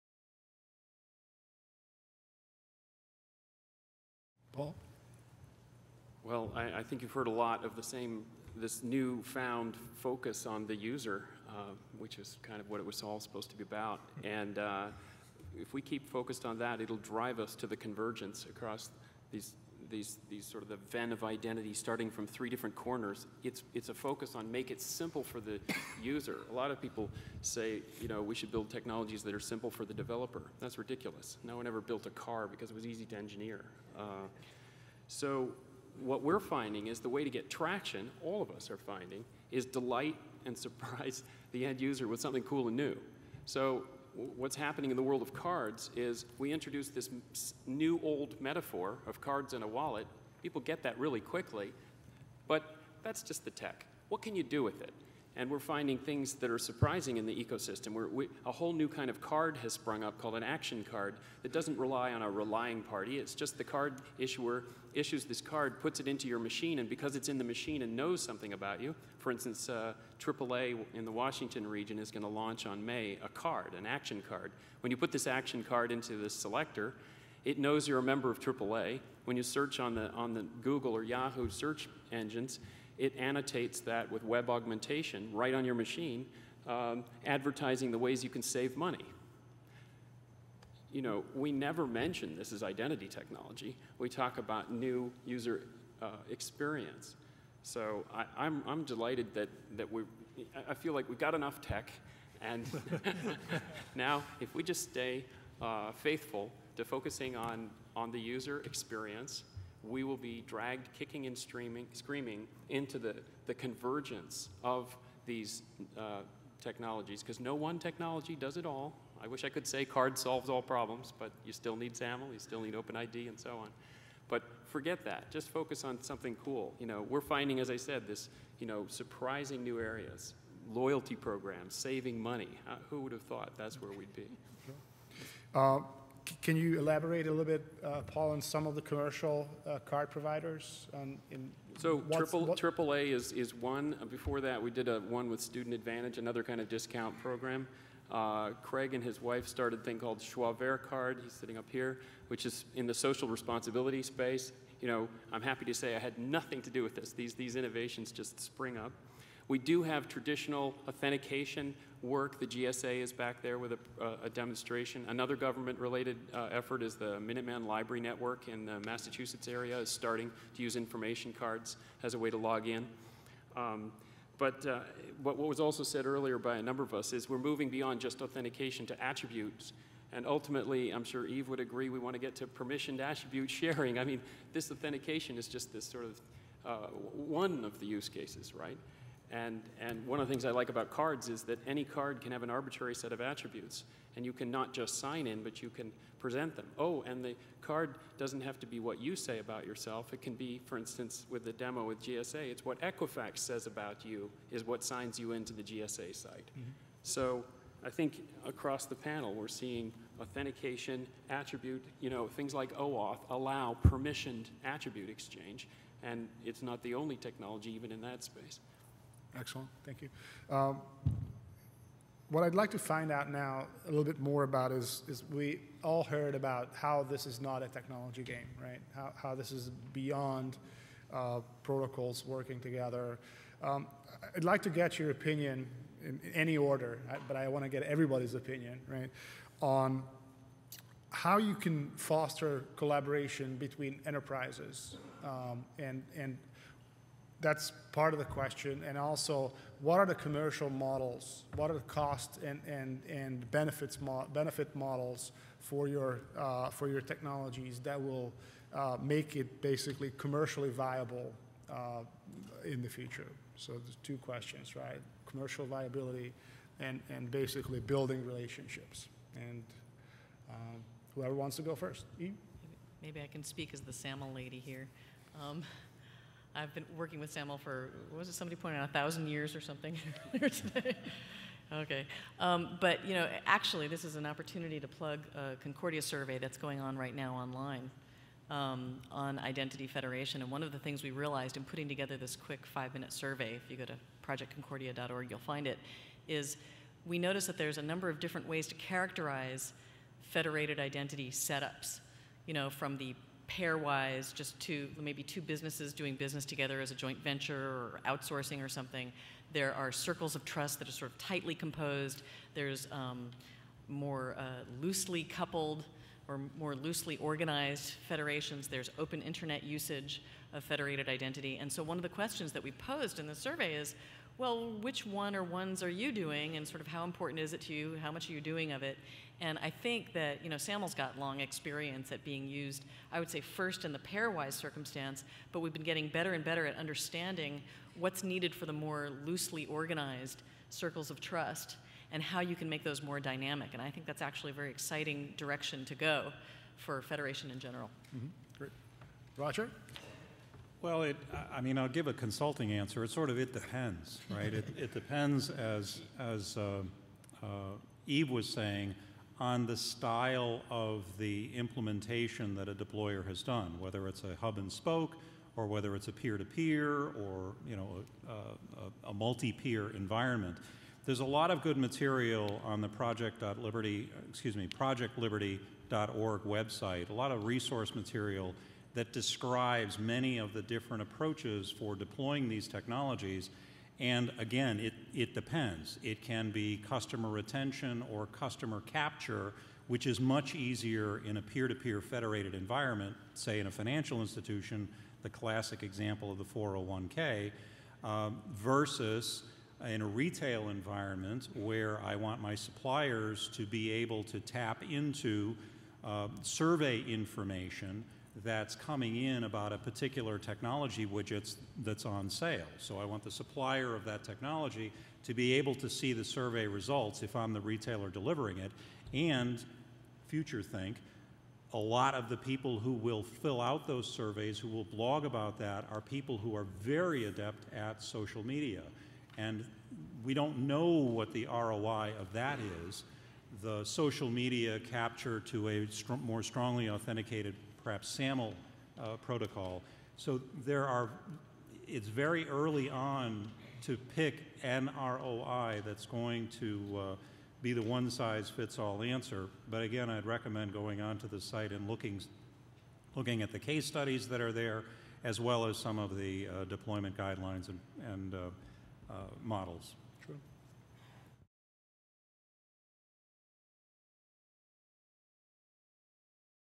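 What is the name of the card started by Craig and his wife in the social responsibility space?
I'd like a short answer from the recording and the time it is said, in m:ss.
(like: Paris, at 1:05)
Schwaber Card, at 2:30.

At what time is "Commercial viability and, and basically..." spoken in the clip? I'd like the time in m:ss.
4:25.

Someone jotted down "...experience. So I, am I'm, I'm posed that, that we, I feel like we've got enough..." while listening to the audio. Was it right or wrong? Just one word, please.
wrong.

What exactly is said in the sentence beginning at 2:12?
Uh, who would have thought that's where we'd be?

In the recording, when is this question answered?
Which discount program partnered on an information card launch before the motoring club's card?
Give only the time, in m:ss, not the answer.
2:25.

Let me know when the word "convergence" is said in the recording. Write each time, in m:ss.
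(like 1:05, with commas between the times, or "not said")
0:17, 1:53.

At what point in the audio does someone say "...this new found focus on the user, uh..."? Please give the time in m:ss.
0:08.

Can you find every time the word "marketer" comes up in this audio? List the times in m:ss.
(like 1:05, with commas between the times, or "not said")
not said.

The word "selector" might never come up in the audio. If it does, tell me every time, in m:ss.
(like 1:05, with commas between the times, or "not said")
1:16.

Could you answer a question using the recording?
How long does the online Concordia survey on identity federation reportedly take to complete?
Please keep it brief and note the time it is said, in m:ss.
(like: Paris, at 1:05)
5, at 4:52.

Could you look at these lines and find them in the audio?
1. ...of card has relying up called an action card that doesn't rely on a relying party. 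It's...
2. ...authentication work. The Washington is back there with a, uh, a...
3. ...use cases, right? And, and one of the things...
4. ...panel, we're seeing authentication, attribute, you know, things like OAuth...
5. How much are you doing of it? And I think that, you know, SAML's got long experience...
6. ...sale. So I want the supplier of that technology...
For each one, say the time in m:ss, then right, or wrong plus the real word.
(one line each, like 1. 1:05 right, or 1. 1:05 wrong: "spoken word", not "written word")
1. 0:59 wrong: "sprung", not "relying"
2. 2:40 wrong: "GSA", not "Washington"
3. 3:07 right
4. 3:28 right
5. 5:28 right
6. 6:52 right.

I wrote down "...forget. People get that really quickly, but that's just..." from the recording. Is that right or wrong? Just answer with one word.
wrong.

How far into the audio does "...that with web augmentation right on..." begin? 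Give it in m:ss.
1:23.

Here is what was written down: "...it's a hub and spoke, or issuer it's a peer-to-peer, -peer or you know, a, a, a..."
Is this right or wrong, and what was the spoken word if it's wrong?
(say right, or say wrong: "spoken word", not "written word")
wrong: "whether", not "issuer".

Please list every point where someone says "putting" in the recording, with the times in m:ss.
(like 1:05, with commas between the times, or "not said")
4:51.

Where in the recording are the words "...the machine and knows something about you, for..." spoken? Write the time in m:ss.
1:07.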